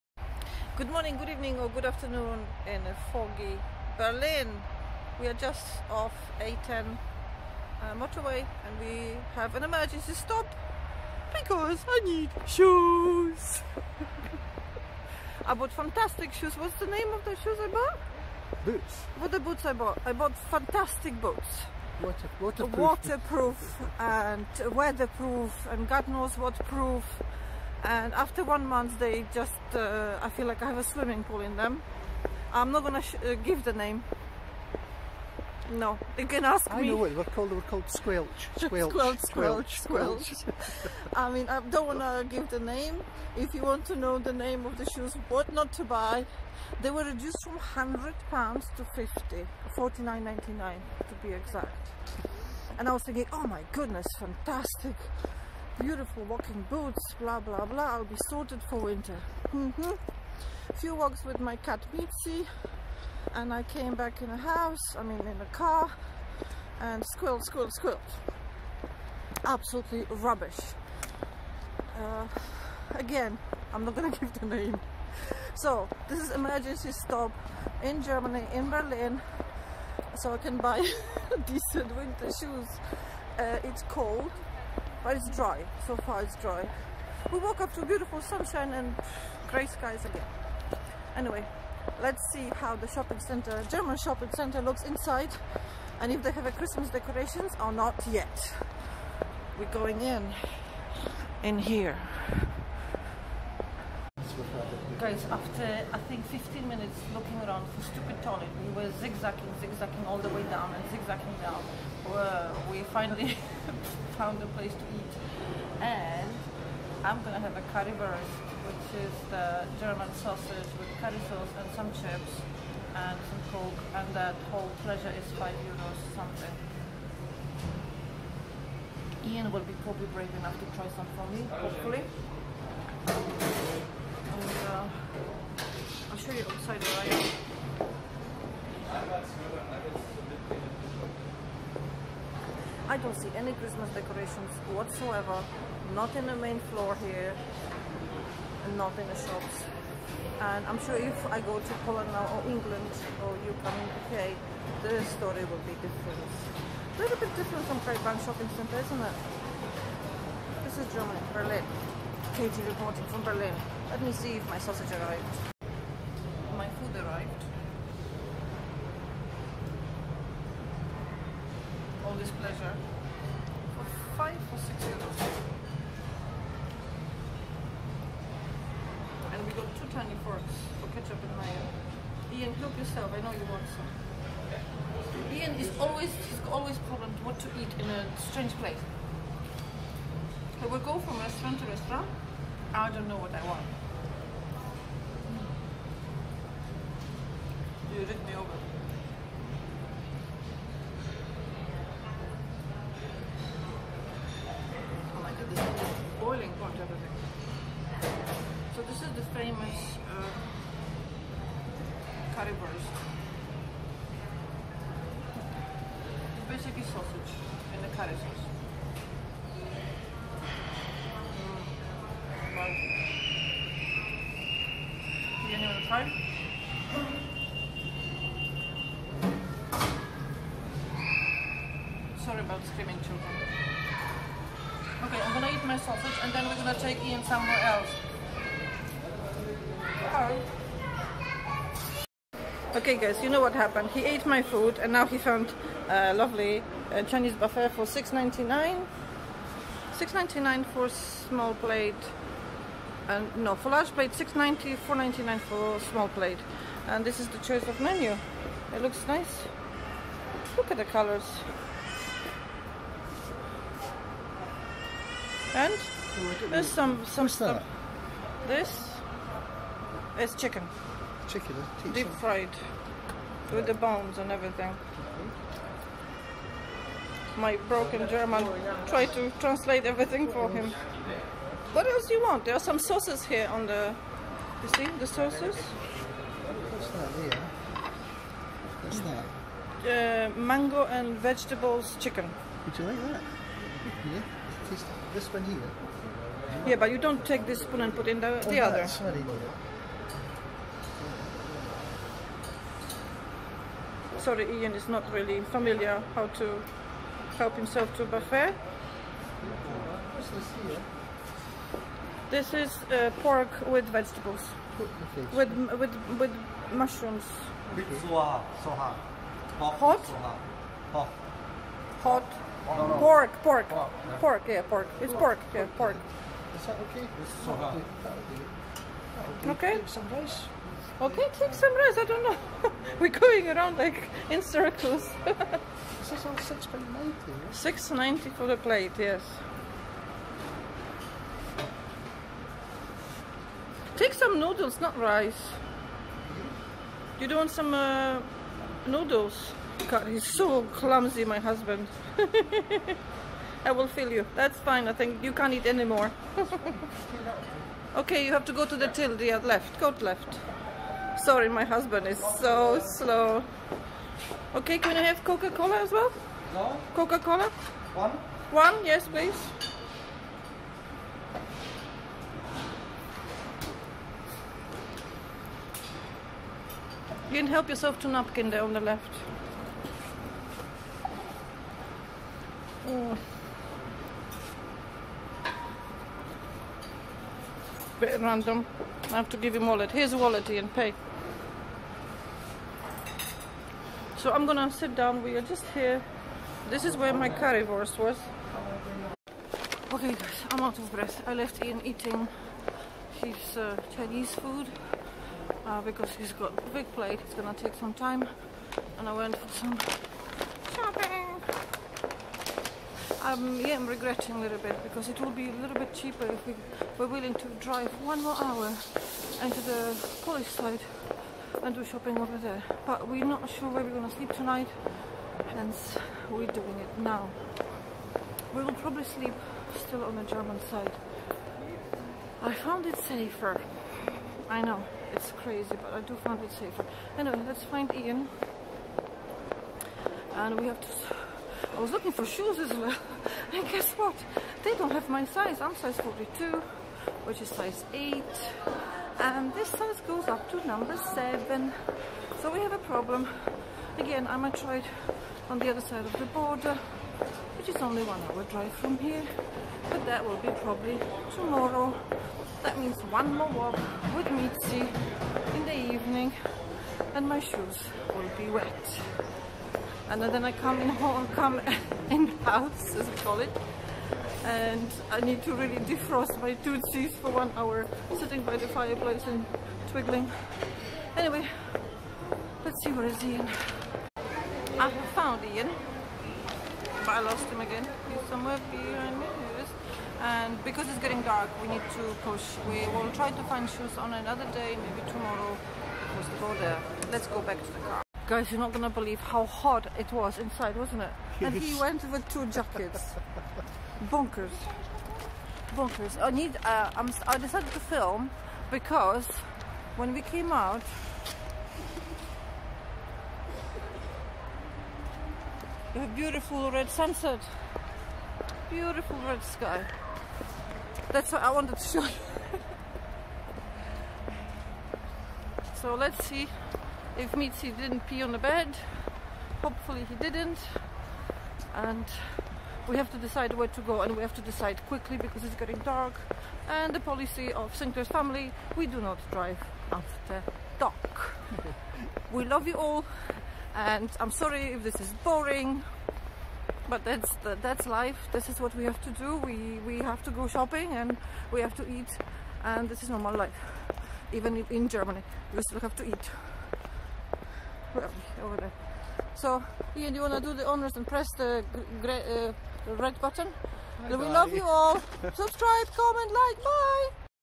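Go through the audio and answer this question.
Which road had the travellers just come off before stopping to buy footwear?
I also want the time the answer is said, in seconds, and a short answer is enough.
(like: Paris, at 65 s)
A10, at 6 s.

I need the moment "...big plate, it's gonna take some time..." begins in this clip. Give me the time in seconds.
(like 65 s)
406 s.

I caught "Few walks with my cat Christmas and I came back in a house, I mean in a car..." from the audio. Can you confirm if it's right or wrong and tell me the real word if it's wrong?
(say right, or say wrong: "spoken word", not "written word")
wrong: "Mitzi", not "Christmas".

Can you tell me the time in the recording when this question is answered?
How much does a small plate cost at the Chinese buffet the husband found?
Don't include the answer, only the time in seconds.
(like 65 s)
254 s.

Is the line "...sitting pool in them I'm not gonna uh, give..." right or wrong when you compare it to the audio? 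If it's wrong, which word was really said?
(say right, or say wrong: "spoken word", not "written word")
wrong: "swimming", not "sitting".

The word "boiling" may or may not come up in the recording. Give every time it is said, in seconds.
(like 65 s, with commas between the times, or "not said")
206 s.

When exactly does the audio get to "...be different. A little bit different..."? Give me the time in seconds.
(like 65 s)
155 s.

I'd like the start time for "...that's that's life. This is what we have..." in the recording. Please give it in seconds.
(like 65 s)
547 s.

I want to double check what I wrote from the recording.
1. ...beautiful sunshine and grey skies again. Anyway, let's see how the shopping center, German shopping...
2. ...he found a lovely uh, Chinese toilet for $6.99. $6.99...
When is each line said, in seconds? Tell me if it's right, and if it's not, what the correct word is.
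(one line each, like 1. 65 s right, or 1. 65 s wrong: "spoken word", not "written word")
1. 87 s right
2. 245 s wrong: "buffet", not "toilet".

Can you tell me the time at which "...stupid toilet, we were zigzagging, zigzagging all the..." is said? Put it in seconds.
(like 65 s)
107 s.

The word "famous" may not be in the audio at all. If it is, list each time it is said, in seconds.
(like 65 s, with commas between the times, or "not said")
209 s.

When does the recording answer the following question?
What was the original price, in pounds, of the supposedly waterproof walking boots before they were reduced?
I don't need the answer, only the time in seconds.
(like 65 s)
47 s.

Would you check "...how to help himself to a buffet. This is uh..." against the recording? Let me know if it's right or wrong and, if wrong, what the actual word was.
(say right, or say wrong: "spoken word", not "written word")
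right.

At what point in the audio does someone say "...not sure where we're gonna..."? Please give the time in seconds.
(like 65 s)
423 s.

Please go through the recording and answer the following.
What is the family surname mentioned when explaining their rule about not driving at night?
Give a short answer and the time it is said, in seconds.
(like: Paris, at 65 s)
Sinclair, at 537 s.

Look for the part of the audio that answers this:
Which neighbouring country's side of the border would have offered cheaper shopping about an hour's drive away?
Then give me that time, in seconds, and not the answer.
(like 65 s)
420 s.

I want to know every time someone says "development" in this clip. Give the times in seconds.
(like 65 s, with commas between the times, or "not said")
not said.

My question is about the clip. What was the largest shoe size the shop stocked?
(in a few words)
7.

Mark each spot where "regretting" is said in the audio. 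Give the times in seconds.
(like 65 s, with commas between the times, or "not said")
413 s.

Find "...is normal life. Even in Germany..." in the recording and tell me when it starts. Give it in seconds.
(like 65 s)
553 s.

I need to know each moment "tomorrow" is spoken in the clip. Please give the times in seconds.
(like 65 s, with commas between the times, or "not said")
461 s, 495 s.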